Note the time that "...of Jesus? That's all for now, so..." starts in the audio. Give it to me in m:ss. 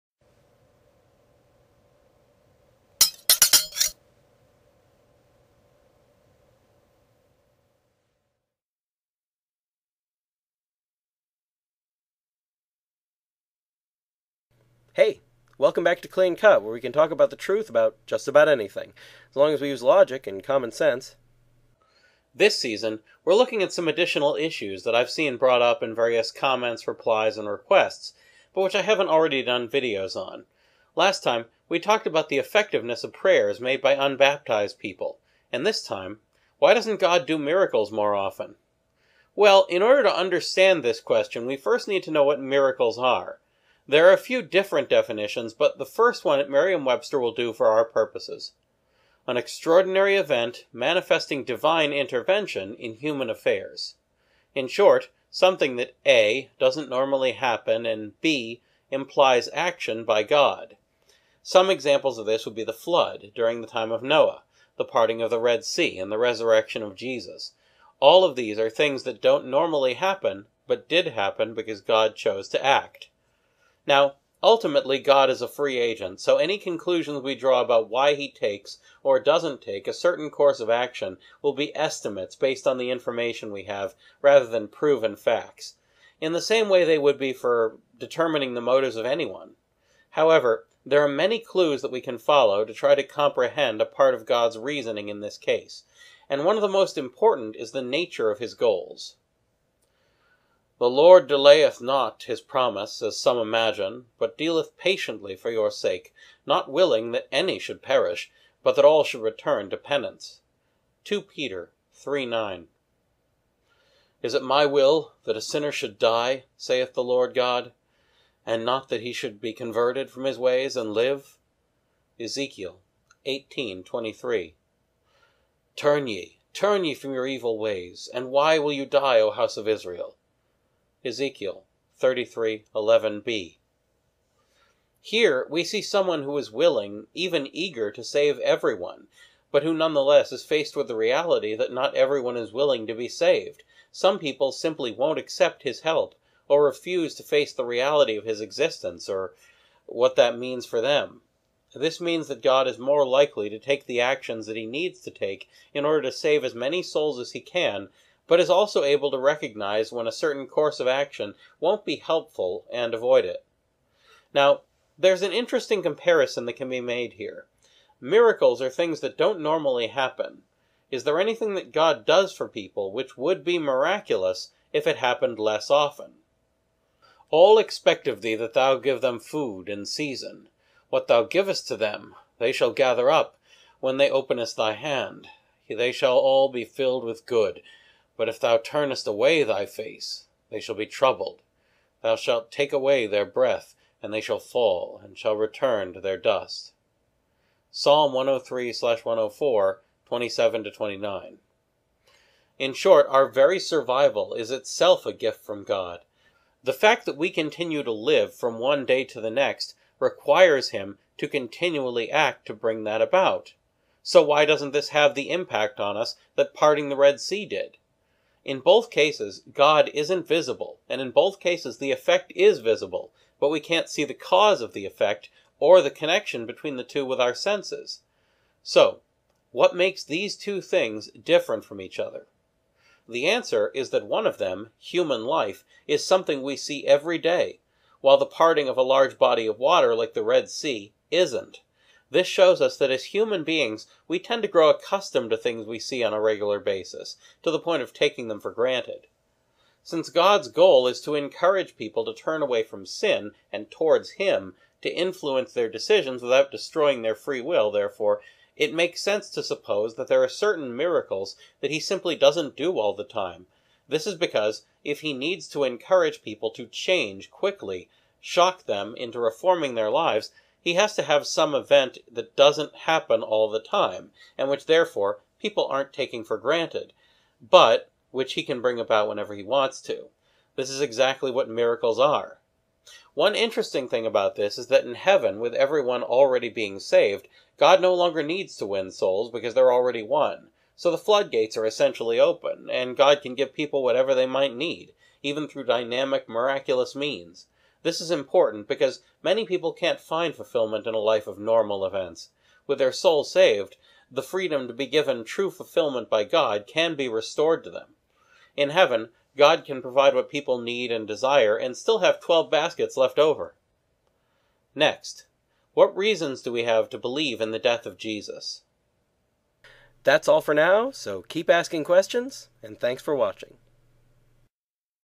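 5:17.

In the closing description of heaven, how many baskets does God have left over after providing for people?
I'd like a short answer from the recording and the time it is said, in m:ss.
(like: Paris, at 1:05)
12, at 5:12.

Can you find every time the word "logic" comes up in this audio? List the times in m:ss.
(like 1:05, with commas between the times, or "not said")
0:19.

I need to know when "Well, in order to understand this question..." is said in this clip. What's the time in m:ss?
0:39.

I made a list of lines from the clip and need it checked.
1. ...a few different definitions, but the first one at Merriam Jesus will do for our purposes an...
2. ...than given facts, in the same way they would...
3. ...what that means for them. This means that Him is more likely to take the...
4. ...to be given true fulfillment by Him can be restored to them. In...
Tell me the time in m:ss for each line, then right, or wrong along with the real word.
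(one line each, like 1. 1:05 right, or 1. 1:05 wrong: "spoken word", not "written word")
1. 0:44 wrong: "Webster", not "Jesus"
2. 1:24 wrong: "proven", not "given"
3. 2:29 wrong: "God", not "Him"
4. 5:04 wrong: "God", not "Him".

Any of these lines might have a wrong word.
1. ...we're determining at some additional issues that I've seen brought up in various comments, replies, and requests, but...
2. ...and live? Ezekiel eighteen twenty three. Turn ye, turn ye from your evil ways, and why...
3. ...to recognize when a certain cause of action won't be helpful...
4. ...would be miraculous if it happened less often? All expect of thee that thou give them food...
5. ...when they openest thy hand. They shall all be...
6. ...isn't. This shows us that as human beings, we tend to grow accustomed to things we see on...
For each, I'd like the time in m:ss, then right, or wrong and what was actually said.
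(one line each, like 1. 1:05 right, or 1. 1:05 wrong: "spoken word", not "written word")
1. 0:23 wrong: "looking", not "determining"
2. 2:00 right
3. 2:39 wrong: "course", not "cause"
4. 2:53 right
5. 3:03 right
6. 4:01 right.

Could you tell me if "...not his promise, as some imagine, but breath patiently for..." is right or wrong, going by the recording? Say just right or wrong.
wrong.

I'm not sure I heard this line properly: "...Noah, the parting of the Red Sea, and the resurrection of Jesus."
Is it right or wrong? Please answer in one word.
right.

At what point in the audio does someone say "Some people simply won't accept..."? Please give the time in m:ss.
2:23.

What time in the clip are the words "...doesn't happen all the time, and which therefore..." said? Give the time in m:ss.
4:32.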